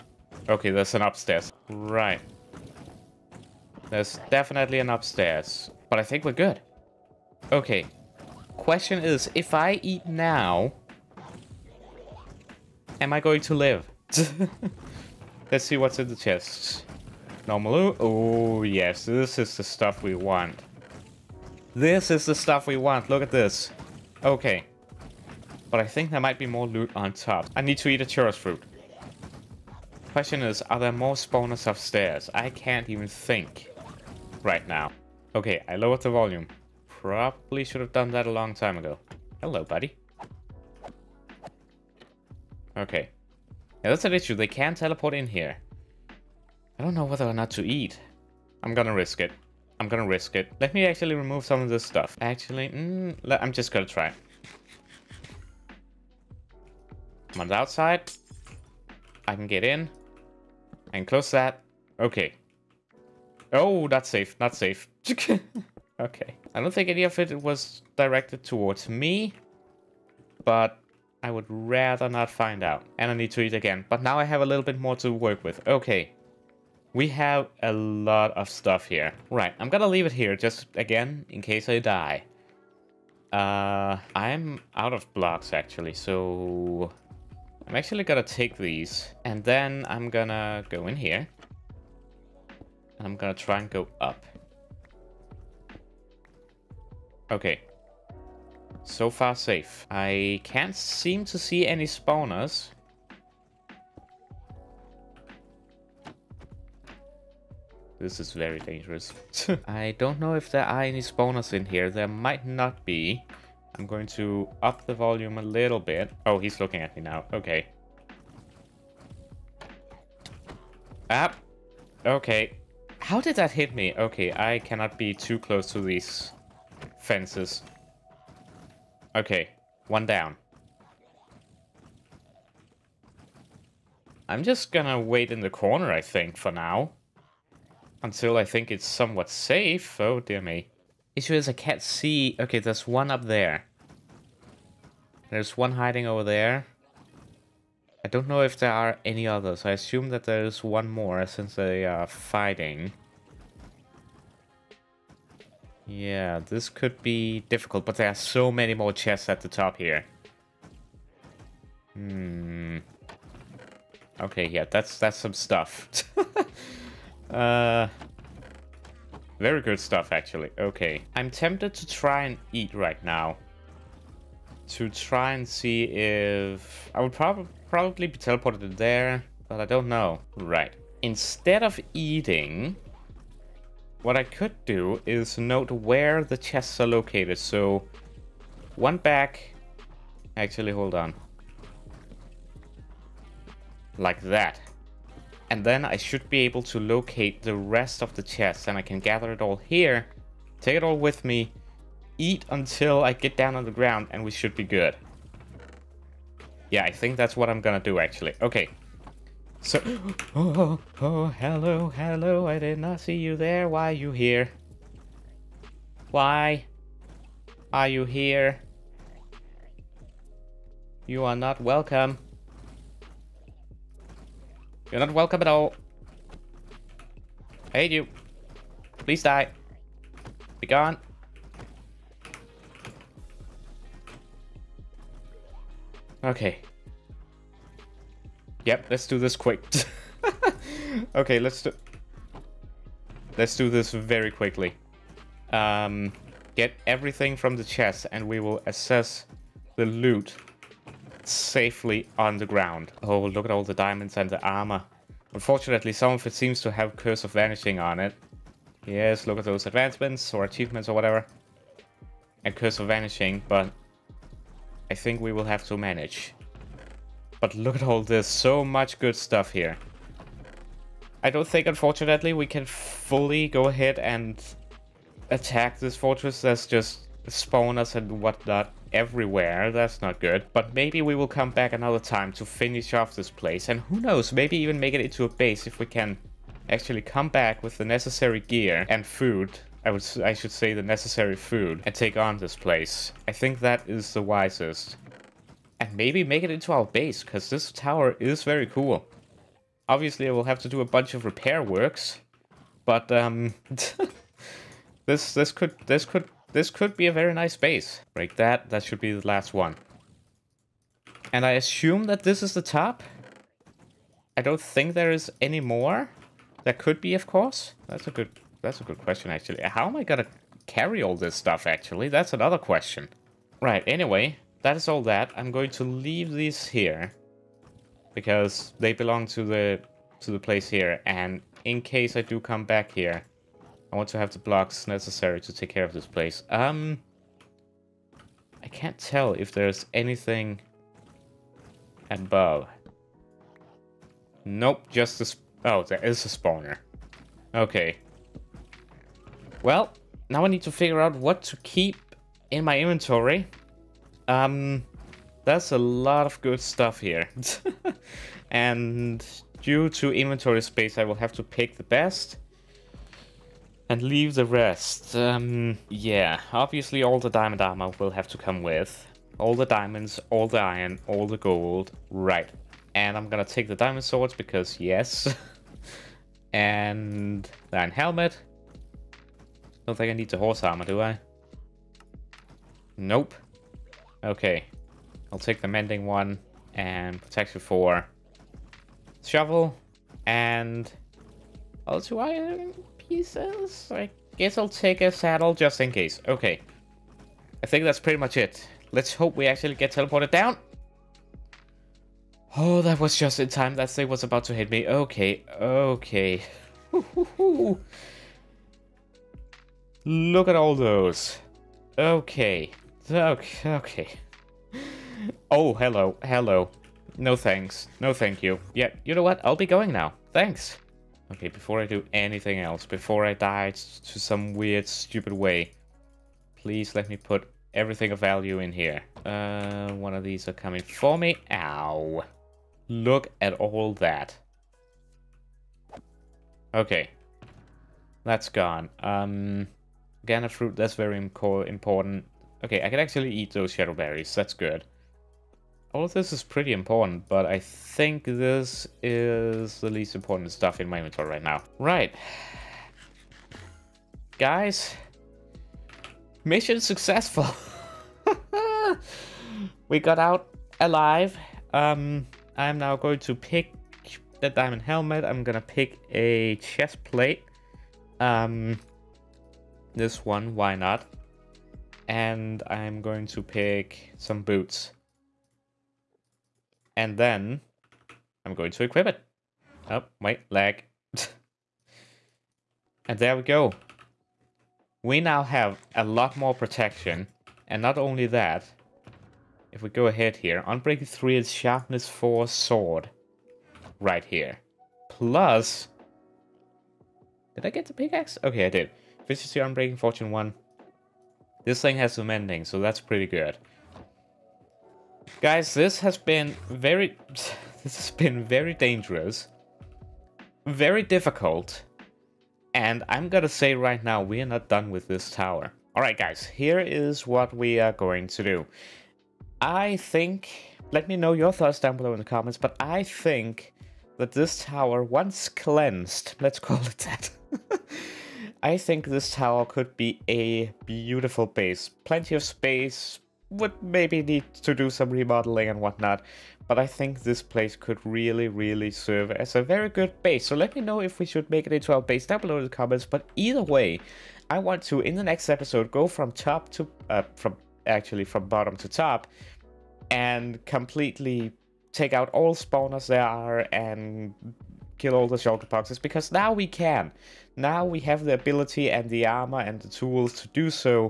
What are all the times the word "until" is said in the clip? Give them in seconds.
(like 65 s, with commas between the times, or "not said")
138 s, 202 s.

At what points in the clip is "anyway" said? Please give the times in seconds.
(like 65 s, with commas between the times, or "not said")
323 s.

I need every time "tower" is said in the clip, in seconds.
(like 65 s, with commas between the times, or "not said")
297 s, 515 s, 524 s, 529 s.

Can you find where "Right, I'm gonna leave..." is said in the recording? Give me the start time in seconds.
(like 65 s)
79 s.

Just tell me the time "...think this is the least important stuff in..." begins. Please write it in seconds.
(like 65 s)
447 s.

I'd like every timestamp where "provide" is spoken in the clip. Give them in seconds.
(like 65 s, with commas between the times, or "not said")
not said.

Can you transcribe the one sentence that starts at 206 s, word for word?
Yeah, I think that's what I'm gonna do actually.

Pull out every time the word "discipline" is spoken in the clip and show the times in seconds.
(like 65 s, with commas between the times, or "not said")
not said.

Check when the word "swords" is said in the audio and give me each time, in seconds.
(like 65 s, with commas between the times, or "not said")
374 s, 492 s.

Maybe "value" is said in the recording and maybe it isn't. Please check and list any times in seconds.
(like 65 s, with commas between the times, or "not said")
428 s.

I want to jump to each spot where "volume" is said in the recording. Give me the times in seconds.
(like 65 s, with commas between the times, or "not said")
36 s, 114 s.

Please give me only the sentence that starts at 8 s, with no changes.
Question is, if I eat now, am I going to live?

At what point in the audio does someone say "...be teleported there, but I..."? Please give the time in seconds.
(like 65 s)
178 s.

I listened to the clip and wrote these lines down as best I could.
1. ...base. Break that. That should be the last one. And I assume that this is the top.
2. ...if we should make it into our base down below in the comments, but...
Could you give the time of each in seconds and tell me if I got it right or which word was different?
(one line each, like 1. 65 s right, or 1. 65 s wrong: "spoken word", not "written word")
1. 307 s right
2. 541 s right.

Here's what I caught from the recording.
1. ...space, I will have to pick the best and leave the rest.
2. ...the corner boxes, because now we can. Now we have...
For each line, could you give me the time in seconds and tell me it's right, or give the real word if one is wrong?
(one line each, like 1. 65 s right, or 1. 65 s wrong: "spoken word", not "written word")
1. 360 s right
2. 555 s wrong: "shulker", not "corner".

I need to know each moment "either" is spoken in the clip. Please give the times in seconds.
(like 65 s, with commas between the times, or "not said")
543 s.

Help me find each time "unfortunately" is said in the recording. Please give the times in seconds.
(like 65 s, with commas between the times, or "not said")
255 s, 271 s.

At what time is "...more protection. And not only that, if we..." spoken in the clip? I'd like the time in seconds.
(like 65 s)
486 s.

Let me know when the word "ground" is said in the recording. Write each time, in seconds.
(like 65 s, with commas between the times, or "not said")
203 s, 252 s.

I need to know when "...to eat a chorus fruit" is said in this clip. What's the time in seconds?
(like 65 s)
27 s.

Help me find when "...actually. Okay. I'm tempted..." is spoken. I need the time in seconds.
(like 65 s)
170 s.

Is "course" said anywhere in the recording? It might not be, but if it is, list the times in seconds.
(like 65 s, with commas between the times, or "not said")
317 s.